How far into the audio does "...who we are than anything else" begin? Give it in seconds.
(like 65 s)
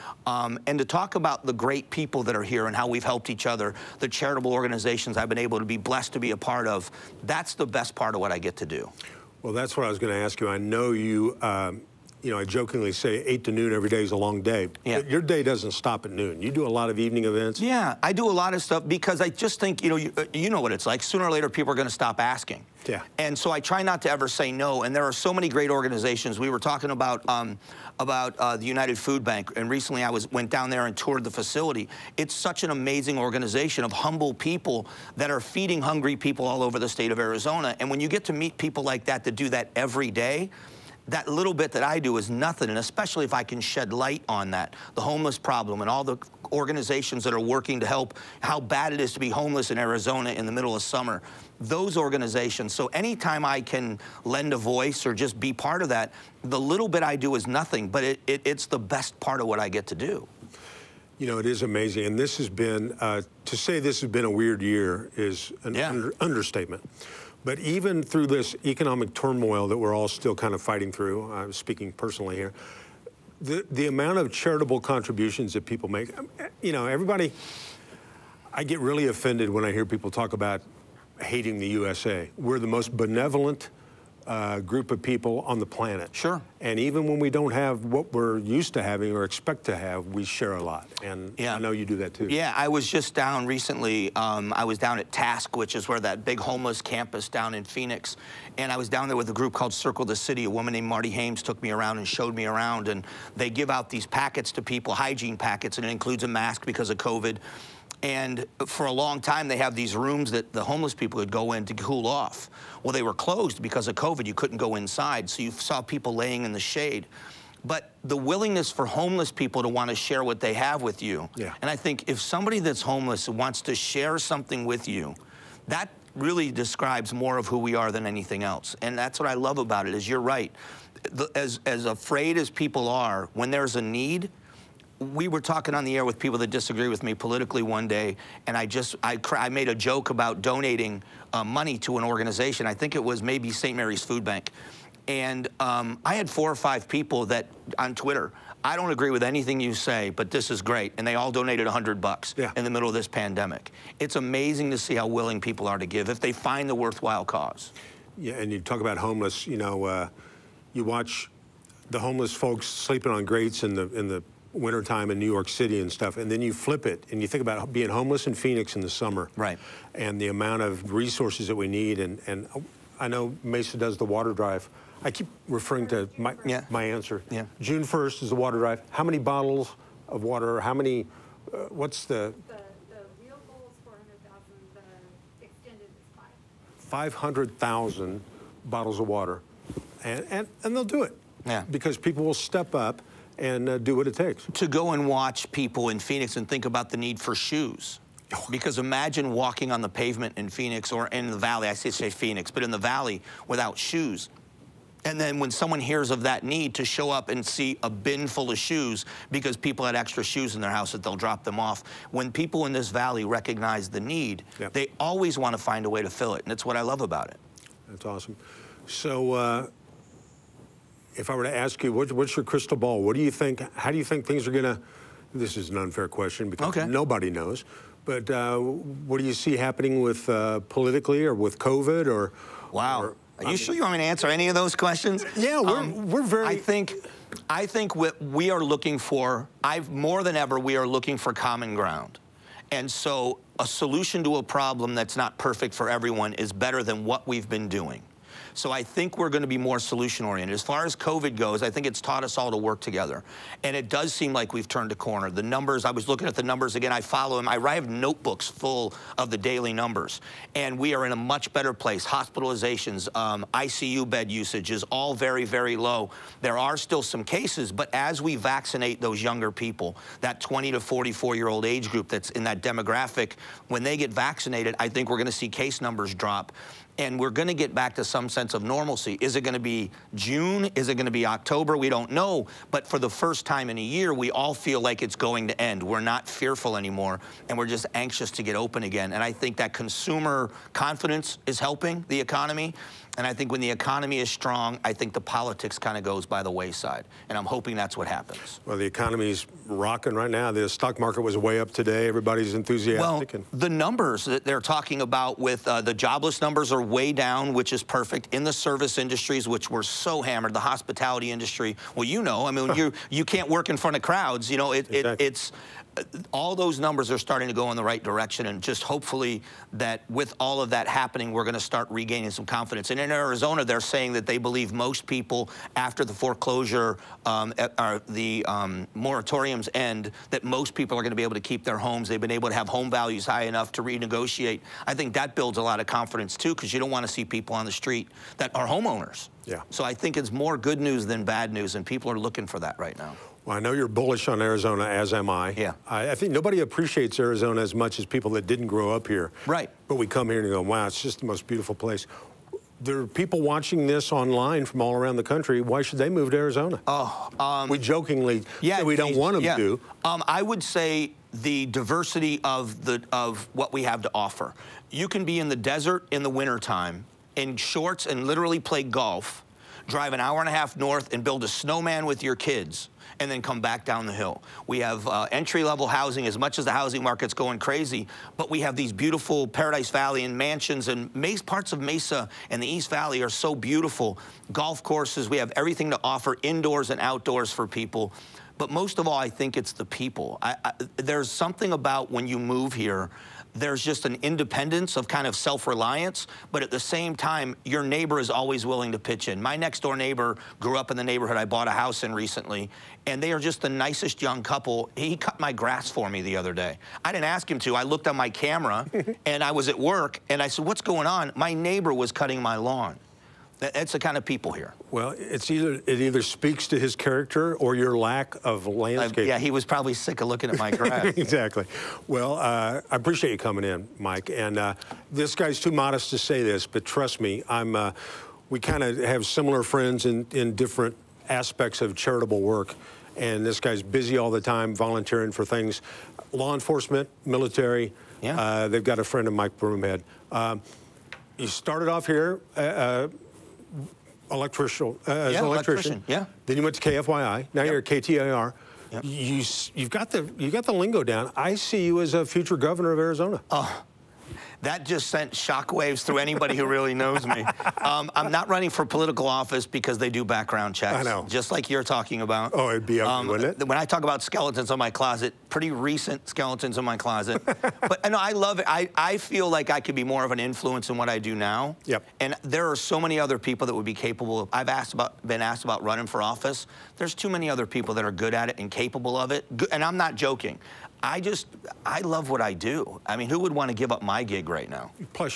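127 s.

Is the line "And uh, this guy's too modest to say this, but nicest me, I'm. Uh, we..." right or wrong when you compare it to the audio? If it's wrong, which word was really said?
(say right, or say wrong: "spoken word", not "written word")
wrong: "trust", not "nicest".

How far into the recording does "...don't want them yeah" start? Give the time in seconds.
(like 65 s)
358 s.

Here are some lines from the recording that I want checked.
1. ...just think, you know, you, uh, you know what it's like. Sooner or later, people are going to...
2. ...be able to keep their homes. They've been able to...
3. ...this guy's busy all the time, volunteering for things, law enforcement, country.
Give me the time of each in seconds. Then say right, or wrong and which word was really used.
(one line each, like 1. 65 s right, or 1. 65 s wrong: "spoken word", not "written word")
1. 19 s right
2. 331 s right
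3. 433 s wrong: "military", not "country".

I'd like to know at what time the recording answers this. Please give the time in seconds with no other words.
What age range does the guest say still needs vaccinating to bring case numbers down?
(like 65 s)
270 s.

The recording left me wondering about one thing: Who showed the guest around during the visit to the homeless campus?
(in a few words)
Marty Hames.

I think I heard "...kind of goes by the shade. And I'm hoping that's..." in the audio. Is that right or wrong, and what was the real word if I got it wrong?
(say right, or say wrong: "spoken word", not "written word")
wrong: "wayside", not "shade".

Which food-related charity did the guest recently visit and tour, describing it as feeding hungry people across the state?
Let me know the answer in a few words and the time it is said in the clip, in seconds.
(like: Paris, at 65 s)
United Food Bank, at 28 s.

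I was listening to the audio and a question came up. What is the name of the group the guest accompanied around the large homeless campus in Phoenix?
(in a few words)
Circle the City.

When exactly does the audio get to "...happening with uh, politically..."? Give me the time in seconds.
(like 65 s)
229 s.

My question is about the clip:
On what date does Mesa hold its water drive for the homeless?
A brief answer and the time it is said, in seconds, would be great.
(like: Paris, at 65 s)
June 1st, at 177 s.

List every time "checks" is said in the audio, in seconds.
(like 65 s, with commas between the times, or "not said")
460 s.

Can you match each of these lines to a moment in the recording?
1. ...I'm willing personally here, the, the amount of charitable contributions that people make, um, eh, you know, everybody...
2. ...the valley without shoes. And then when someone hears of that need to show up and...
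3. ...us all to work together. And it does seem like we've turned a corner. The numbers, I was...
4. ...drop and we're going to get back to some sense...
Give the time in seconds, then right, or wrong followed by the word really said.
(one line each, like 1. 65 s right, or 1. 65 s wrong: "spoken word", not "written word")
1. 71 s wrong: "speaking", not "willing"
2. 202 s right
3. 252 s right
4. 276 s right.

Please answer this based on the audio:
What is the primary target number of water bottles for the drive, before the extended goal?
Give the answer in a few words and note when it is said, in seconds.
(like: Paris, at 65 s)
400,000, at 183 s.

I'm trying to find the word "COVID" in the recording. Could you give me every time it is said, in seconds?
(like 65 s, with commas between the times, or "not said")
106 s, 113 s, 231 s, 250 s.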